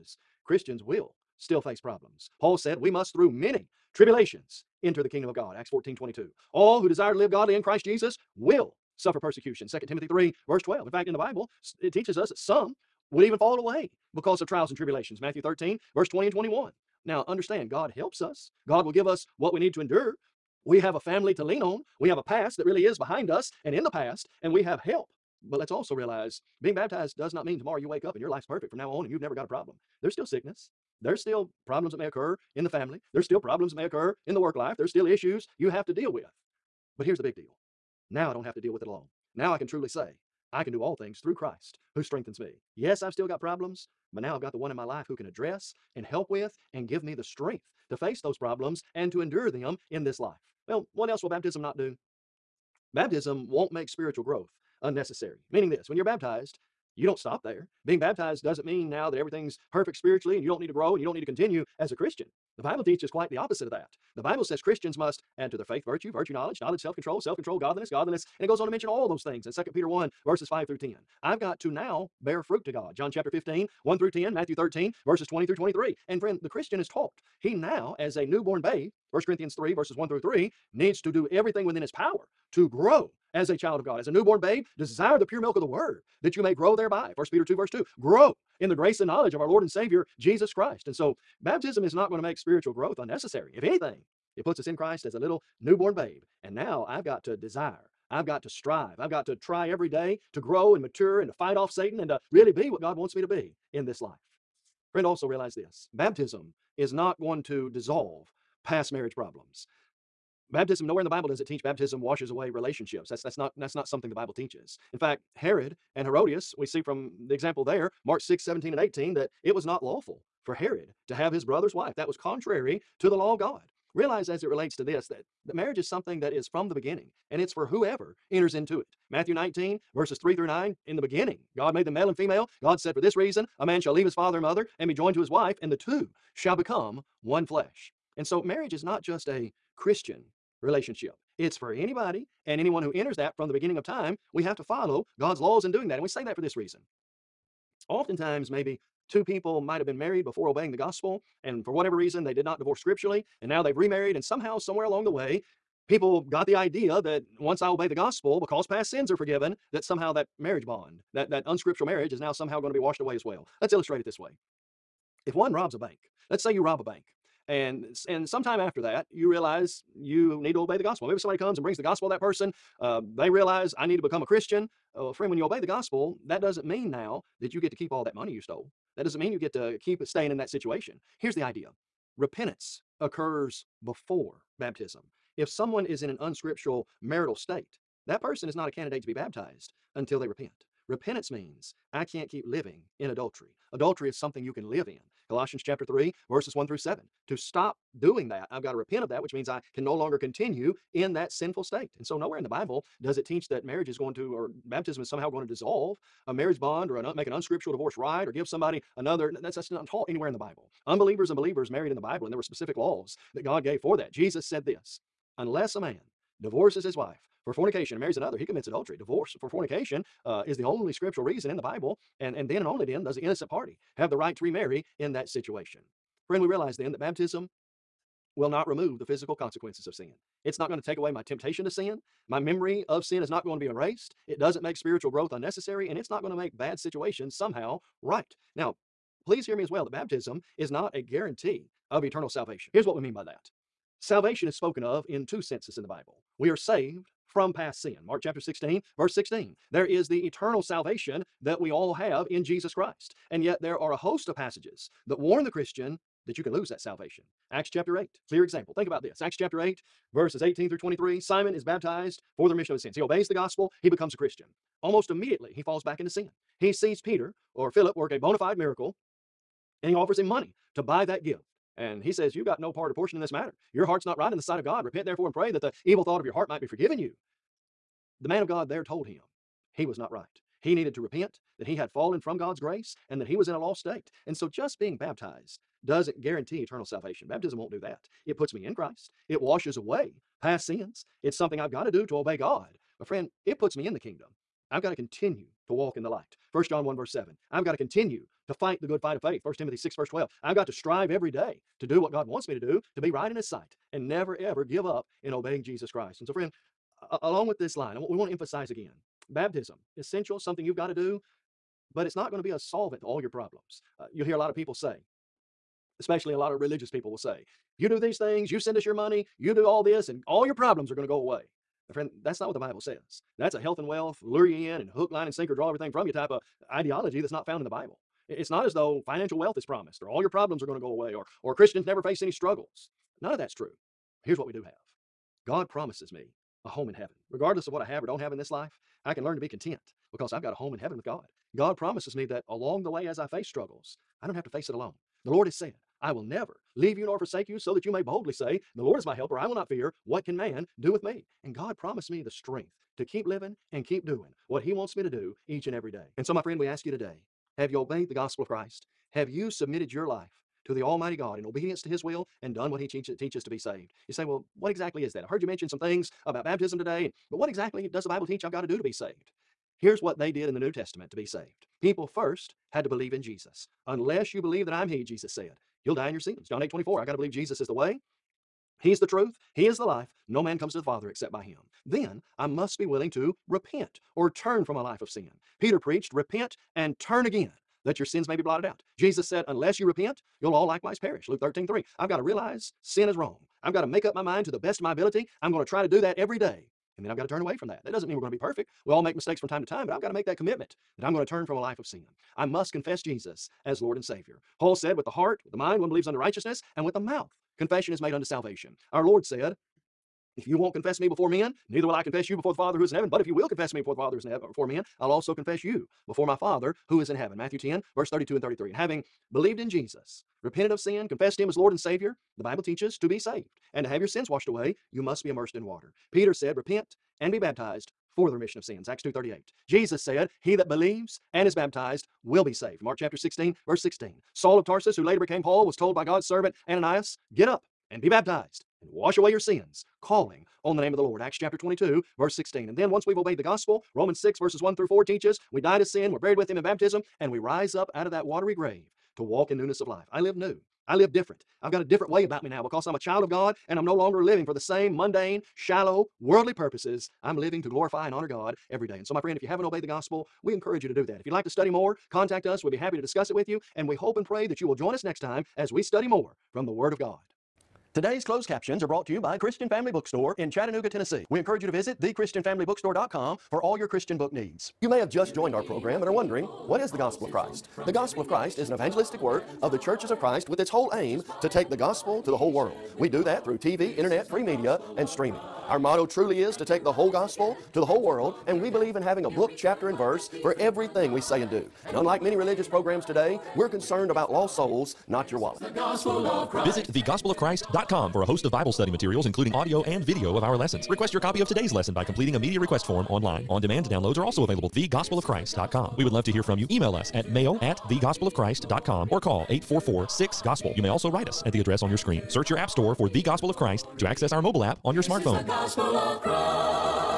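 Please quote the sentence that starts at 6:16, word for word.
John 8 24, I got to believe Jesus is the way, He's the truth, He is the life.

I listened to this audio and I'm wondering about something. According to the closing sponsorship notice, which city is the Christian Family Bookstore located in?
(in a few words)
Chattanooga, Tennessee.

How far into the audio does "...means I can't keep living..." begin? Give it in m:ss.
3:11.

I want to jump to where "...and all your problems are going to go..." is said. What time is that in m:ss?
5:20.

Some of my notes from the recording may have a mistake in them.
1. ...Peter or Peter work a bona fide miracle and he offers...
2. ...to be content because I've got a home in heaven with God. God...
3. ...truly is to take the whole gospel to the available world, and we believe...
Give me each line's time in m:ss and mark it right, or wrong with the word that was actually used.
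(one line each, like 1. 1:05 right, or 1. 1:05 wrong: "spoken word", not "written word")
1. 4:26 wrong: "Philip", not "Peter"
2. 5:39 right
3. 8:06 wrong: "whole", not "available".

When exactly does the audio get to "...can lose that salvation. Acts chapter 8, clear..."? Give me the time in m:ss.
4:16.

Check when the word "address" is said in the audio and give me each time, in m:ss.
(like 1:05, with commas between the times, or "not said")
0:45, 8:31.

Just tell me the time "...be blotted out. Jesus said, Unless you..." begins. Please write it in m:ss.
6:28.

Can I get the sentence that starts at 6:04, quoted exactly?
You say, well, what exactly is that?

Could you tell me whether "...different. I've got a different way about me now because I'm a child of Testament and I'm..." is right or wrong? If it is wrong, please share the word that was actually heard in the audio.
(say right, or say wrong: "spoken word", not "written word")
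wrong: "God", not "Testament".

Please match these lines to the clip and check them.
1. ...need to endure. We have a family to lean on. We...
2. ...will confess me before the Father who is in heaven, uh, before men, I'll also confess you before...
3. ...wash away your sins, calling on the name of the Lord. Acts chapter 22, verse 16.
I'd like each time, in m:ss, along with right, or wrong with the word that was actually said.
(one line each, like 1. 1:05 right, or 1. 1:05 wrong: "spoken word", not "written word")
1. 0:19 right
2. 6:53 right
3. 7:18 right.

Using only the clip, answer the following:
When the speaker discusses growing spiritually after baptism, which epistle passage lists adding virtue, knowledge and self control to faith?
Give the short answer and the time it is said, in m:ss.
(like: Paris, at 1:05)
2 Peter 1:5-10, at 1:09.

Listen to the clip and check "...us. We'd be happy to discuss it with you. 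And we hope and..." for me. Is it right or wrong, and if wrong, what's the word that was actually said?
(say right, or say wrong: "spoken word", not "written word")
right.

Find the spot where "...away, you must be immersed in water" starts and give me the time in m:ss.
7:04.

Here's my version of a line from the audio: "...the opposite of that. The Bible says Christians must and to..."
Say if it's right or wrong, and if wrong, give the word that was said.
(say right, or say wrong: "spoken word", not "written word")
right.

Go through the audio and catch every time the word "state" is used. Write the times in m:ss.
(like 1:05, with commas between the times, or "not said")
3:07, 3:21, 4:43.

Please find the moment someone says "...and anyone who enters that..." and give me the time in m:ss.
2:22.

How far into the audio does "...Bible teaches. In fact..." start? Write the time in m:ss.
1:54.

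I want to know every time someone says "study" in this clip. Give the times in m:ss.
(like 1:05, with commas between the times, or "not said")
7:41, 7:45, 8:18.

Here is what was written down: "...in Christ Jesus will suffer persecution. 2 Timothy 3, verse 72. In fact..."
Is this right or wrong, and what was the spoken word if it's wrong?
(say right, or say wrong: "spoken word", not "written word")
wrong: "12", not "72".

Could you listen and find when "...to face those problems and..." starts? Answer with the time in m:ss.
0:47.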